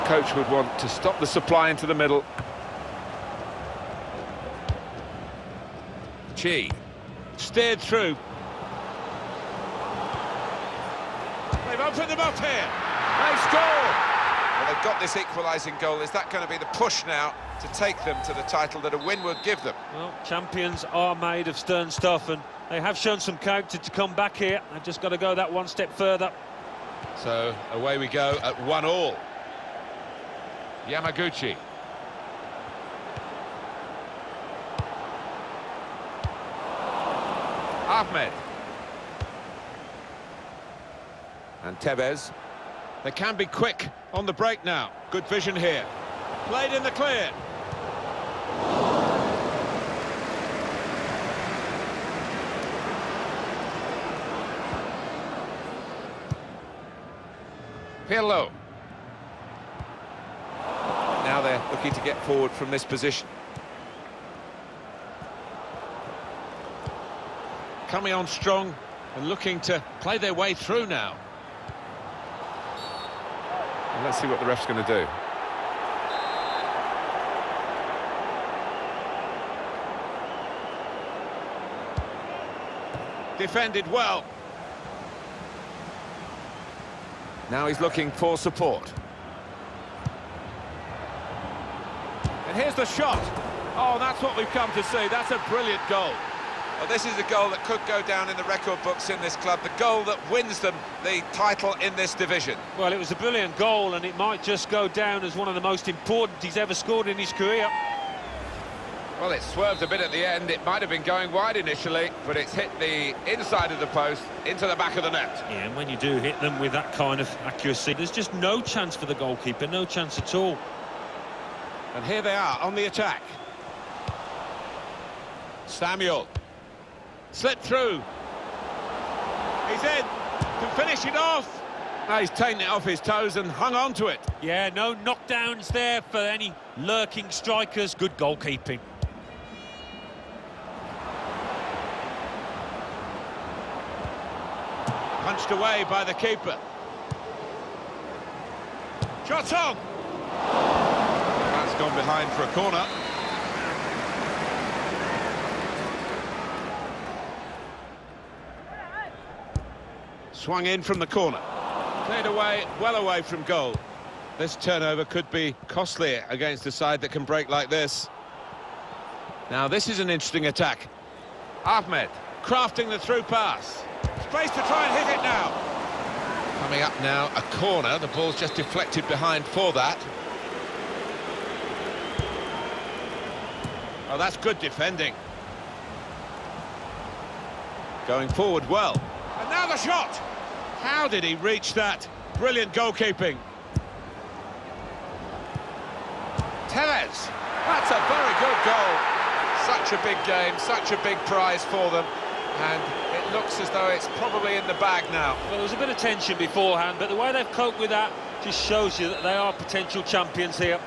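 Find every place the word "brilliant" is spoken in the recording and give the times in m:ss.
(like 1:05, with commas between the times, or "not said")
1:35, 1:43, 3:12.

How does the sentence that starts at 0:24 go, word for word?
They've just got to go that one step further.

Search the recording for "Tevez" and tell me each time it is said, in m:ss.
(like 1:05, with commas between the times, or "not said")
0:41, 3:16.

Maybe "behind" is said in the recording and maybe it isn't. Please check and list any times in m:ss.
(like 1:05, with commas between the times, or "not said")
2:31, 2:59.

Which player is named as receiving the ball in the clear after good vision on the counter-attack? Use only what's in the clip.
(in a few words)
Pirlo.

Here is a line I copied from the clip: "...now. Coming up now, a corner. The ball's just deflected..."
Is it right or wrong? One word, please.
right.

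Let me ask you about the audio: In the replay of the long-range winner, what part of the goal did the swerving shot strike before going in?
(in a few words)
Inside of the post.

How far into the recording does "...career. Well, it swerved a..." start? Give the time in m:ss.
1:47.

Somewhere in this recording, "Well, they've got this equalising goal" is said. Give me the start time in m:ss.
0:14.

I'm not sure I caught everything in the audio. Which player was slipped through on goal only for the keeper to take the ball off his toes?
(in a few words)
Samuel.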